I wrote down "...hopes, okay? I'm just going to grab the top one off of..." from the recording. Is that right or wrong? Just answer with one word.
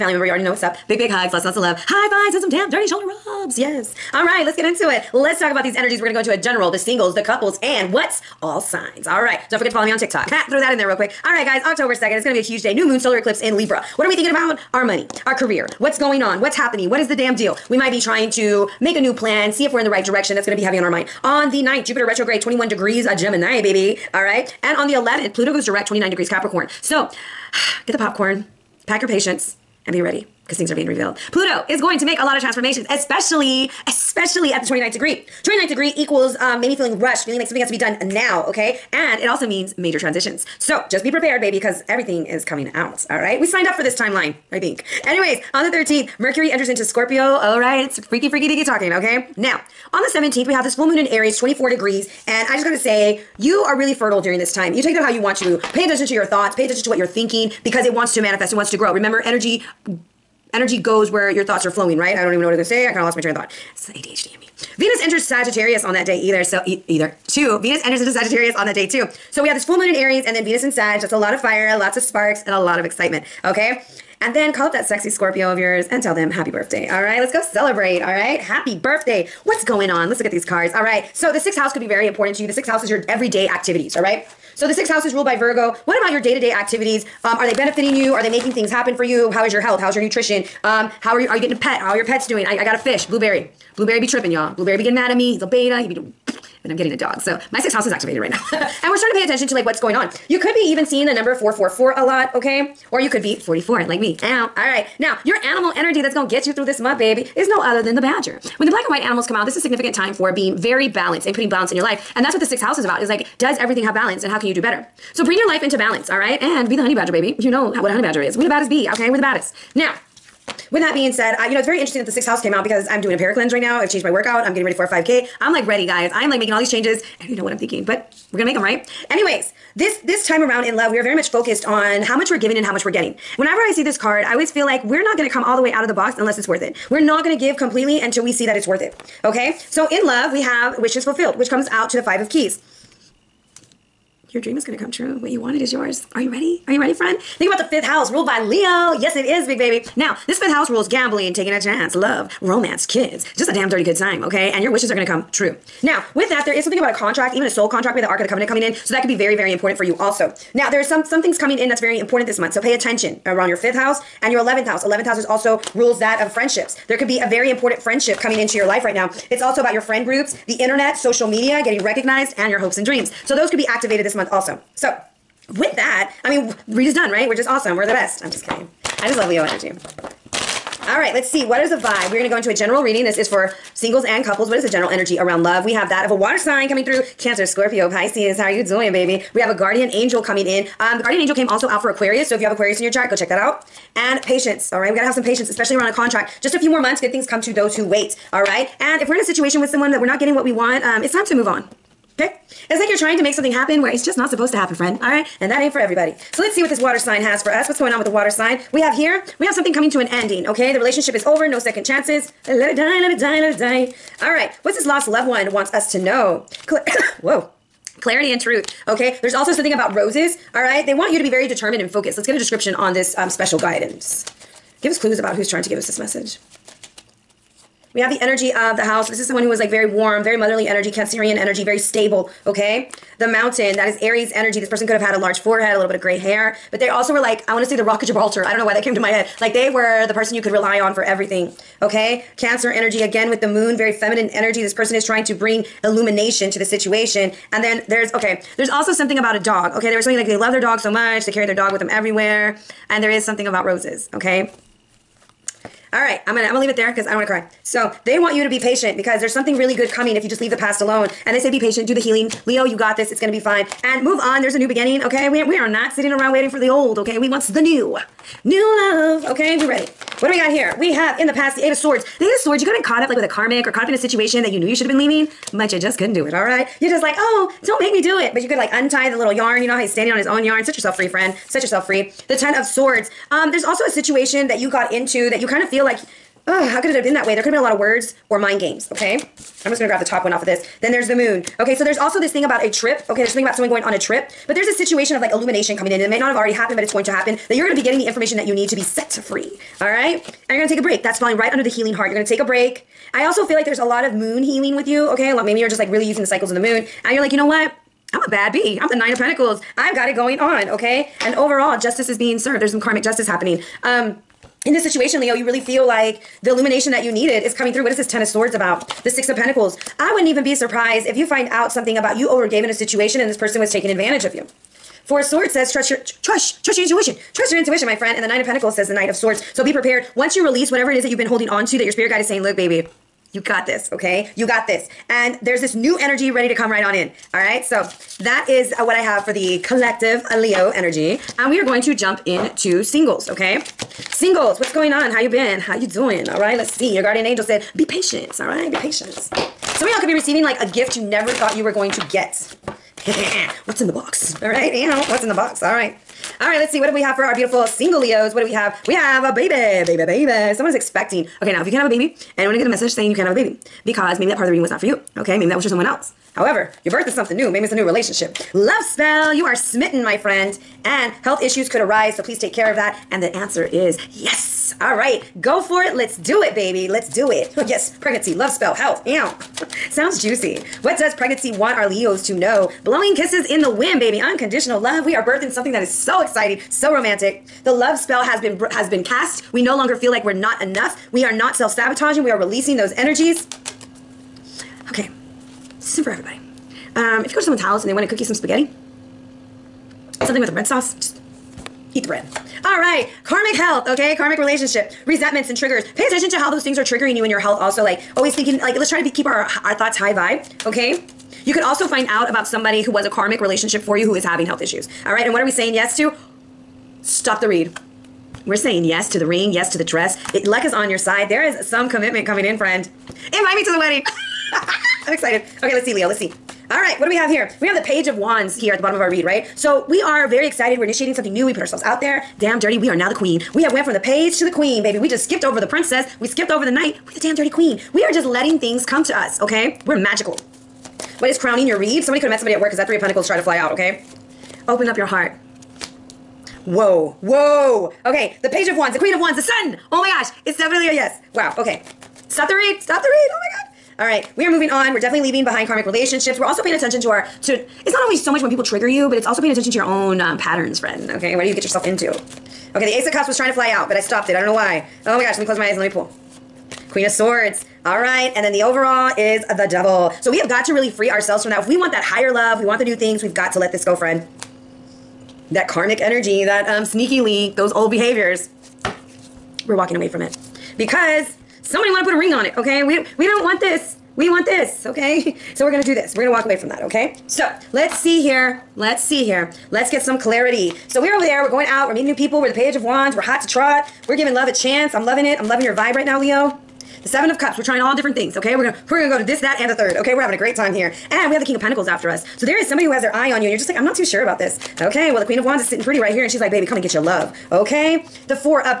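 wrong.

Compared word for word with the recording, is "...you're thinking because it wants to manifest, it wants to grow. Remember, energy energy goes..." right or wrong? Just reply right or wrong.
right.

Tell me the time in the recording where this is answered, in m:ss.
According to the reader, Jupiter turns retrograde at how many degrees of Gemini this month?
0:22.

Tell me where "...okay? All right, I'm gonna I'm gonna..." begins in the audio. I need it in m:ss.
4:14.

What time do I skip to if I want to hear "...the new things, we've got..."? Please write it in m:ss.
7:52.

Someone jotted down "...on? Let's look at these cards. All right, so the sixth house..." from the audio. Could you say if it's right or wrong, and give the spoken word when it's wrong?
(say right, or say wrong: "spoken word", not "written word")
right.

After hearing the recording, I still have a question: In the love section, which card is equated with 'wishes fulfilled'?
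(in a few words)
Five of Keys.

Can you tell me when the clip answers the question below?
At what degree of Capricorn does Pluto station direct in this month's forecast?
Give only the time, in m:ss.
0:25.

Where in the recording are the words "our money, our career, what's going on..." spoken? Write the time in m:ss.
0:14.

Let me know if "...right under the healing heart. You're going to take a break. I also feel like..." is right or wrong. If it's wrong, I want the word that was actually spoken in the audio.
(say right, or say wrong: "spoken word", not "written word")
right.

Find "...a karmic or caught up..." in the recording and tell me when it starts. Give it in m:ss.
4:33.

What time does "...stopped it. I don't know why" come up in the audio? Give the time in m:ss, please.
7:43.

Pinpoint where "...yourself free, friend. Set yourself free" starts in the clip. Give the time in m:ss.
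4:40.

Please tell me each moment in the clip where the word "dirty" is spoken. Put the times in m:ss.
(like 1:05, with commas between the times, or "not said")
0:02, 2:33, 7:12, 7:17.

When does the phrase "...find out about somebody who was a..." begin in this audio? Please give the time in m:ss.
6:51.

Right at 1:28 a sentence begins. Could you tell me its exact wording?
Are they making things happen for you?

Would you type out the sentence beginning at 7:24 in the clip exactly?
Open up your heart Whoa, whoa.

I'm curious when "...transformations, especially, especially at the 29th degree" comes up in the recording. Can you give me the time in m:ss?
0:32.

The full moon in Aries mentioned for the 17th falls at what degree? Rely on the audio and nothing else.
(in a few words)
24.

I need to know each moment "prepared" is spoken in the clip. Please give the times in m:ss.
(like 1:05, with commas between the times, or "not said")
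0:41, 5:29.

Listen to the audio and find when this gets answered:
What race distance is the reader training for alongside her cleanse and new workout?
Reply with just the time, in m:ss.
2:04.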